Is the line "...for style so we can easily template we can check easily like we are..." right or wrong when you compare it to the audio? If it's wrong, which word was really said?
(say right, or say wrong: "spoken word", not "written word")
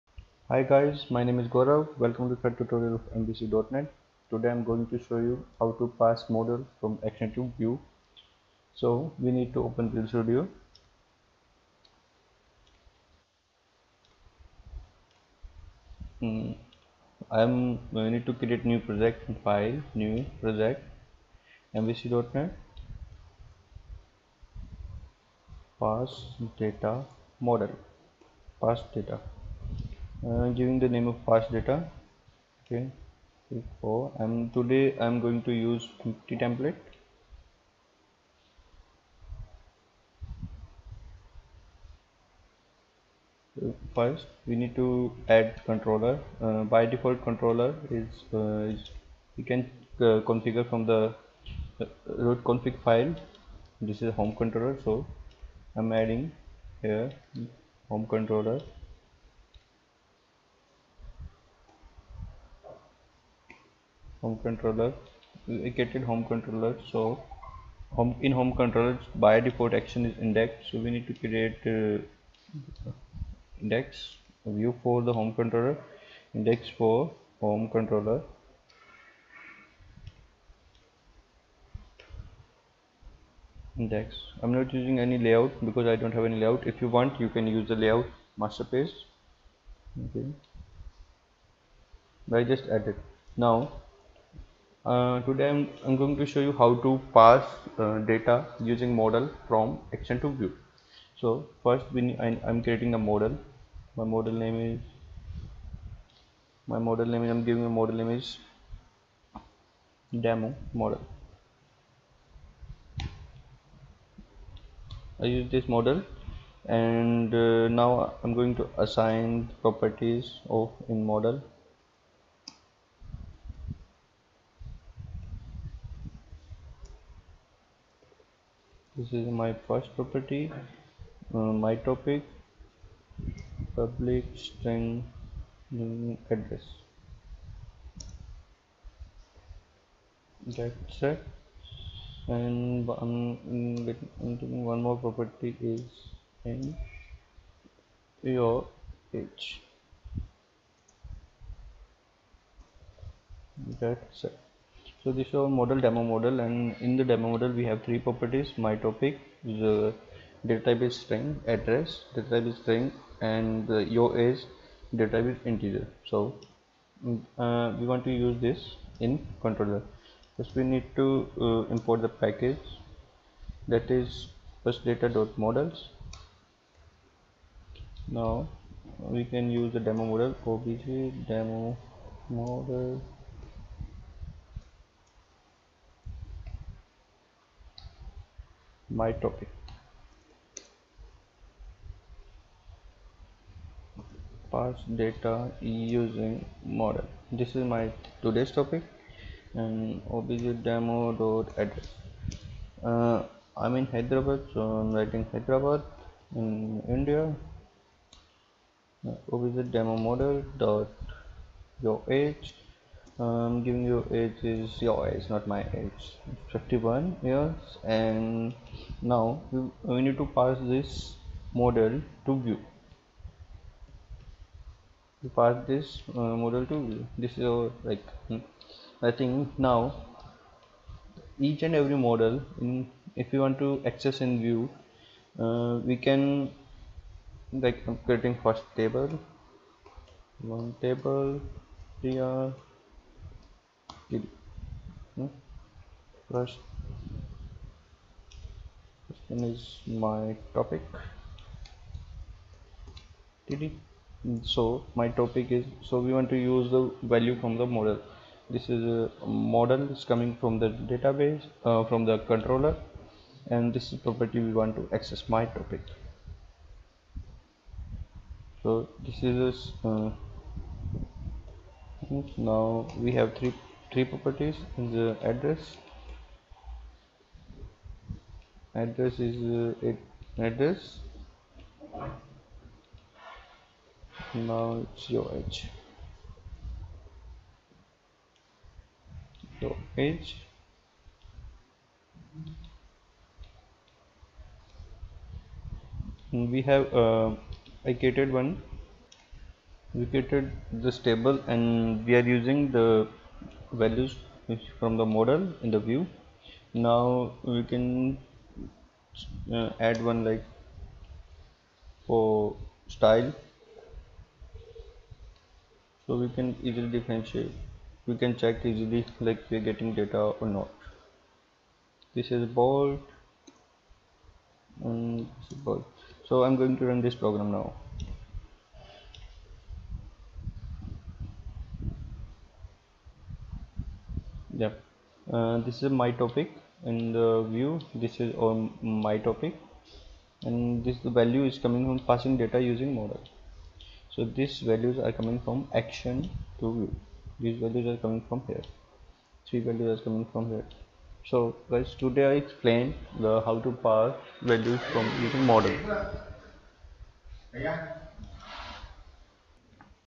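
wrong: "differentiate", not "template".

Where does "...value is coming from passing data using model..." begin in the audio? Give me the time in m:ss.
5:41.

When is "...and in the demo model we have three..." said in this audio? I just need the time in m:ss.
2:36.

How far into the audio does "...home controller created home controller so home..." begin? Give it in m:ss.
1:04.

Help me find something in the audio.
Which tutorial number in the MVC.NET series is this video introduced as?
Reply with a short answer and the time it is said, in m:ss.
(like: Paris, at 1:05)
Third, at 0:02.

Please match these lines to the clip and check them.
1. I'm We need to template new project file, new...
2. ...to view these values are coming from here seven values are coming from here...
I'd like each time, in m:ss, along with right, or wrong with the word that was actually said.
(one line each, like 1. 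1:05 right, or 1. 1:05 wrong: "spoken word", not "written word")
1. 0:17 wrong: "create", not "template"
2. 5:46 wrong: "three", not "seven".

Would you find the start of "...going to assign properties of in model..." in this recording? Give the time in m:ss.
1:58.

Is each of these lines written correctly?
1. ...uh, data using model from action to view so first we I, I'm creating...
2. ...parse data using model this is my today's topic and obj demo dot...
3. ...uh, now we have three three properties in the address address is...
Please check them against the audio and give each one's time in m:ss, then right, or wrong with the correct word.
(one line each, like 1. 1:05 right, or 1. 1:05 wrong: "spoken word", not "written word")
1. 1:37 right
2. 3:14 right
3. 4:29 right.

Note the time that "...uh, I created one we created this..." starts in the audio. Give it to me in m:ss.
4:57.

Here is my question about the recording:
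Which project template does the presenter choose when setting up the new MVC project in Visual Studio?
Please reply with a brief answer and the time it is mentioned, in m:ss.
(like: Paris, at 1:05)
Empty template, at 0:36.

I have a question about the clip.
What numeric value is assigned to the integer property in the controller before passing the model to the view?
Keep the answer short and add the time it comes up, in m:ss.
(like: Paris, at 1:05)
51, at 3:36.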